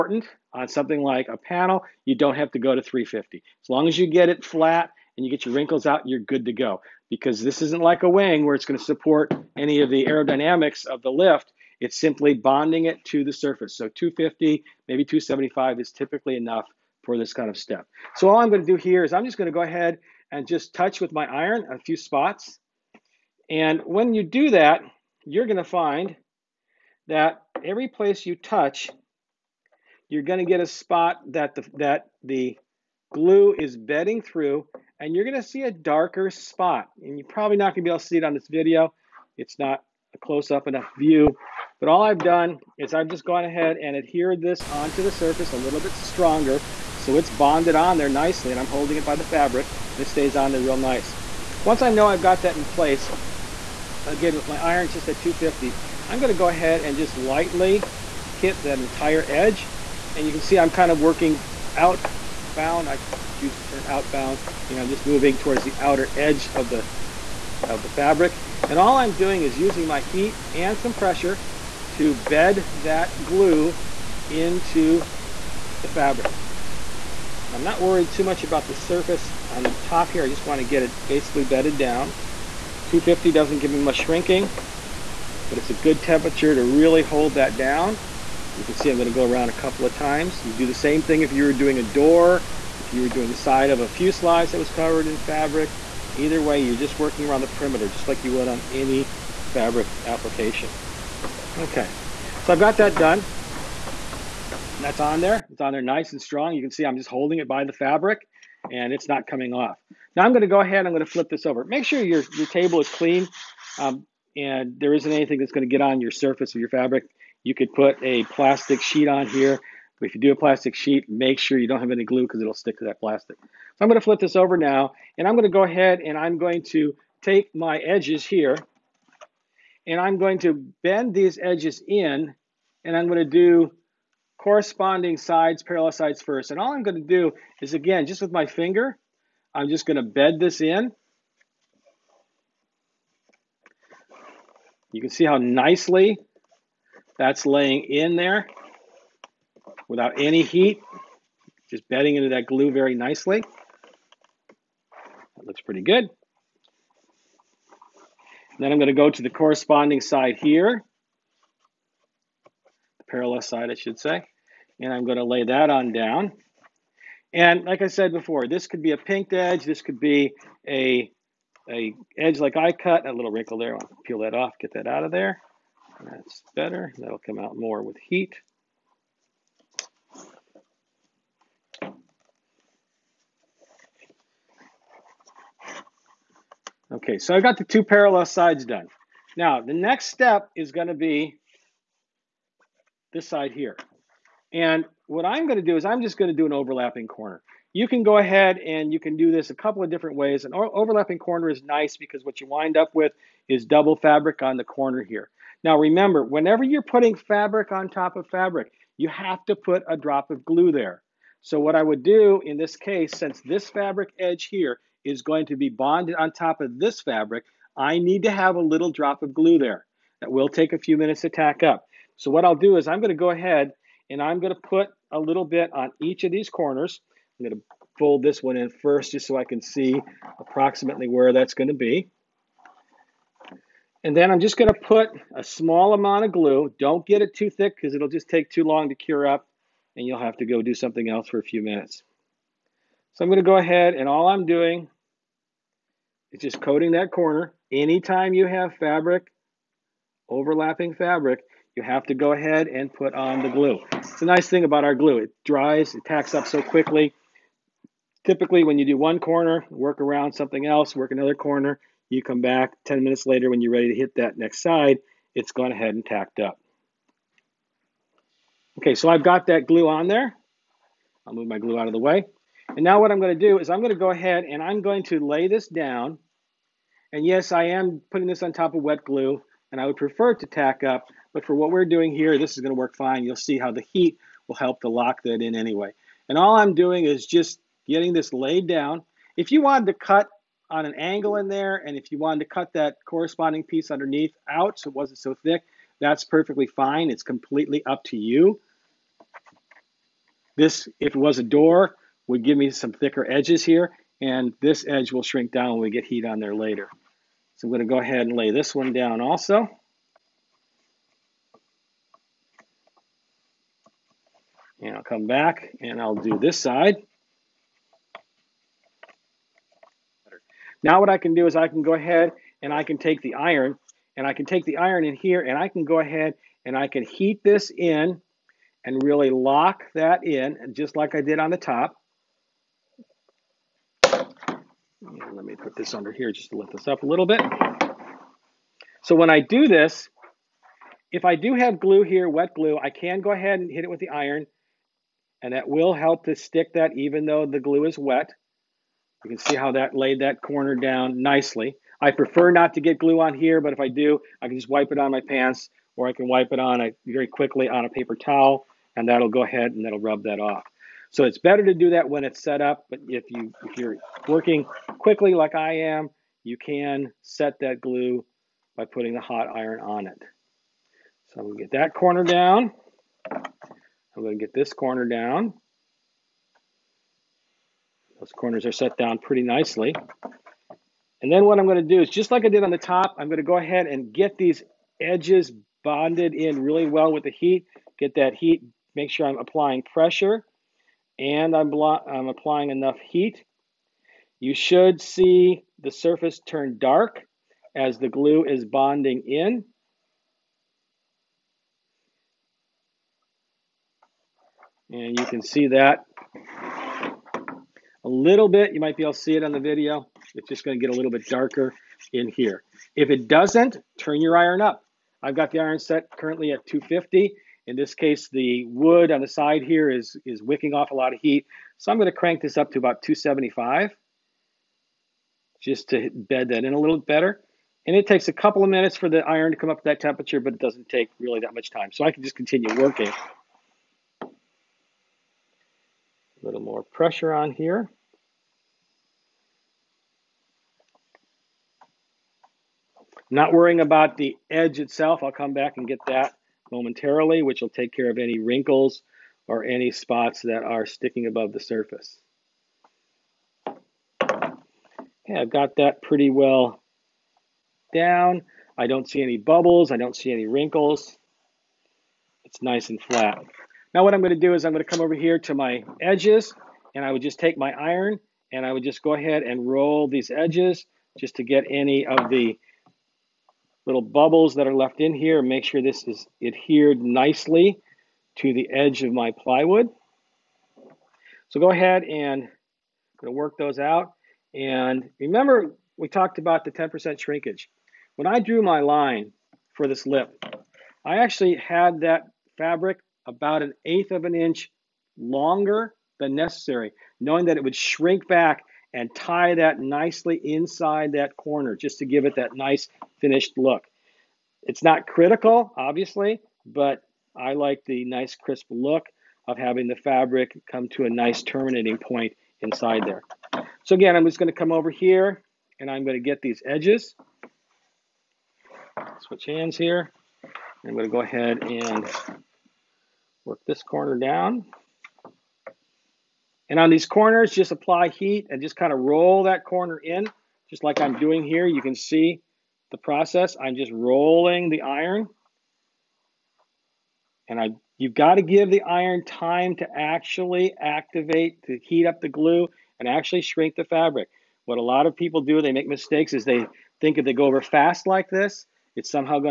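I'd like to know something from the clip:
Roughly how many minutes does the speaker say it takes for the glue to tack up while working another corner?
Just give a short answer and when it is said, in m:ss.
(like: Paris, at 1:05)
10 minutes, at 4:22.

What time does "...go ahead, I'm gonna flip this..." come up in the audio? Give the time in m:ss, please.
1:50.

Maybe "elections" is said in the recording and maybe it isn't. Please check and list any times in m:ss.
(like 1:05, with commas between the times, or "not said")
not said.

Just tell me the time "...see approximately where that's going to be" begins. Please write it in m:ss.
3:49.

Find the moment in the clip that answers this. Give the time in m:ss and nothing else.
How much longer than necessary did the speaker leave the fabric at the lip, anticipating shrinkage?
8:13.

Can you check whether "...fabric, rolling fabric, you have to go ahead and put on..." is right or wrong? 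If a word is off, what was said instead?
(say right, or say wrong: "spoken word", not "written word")
wrong: "overlapping", not "rolling".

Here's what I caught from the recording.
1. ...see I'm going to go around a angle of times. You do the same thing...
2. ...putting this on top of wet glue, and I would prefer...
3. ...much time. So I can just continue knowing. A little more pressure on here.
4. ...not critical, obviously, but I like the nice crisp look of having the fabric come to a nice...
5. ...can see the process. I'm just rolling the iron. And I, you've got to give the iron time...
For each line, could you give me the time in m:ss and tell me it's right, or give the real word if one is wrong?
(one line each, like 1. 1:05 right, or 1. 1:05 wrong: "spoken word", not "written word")
1. 1:28 wrong: "couple", not "angle"
2. 4:38 right
3. 7:11 wrong: "working", not "knowing"
4. 8:24 right
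5. 8:51 right.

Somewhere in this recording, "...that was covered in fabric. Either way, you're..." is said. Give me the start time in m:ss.
1:34.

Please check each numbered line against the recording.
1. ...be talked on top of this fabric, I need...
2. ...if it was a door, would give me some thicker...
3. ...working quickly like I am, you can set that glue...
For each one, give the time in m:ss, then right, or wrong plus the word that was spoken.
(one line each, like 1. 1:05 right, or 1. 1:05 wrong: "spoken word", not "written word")
1. 3:35 wrong: "bonded", not "talked"
2. 5:00 right
3. 6:04 right.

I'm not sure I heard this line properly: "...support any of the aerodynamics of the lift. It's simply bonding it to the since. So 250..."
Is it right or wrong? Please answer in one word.
wrong.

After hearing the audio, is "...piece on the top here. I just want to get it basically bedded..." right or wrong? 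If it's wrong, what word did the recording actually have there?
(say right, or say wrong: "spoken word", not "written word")
wrong: "surface", not "piece".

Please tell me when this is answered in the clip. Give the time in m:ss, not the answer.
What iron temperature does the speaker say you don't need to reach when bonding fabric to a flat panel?
0:02.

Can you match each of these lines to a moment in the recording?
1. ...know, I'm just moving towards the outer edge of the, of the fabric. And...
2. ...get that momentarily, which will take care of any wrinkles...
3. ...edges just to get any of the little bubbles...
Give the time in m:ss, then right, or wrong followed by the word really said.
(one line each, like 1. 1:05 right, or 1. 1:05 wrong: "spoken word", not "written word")
1. 1:04 right
2. 7:25 right
3. 7:50 right.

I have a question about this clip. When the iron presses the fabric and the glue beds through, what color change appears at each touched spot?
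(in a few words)
darker spot.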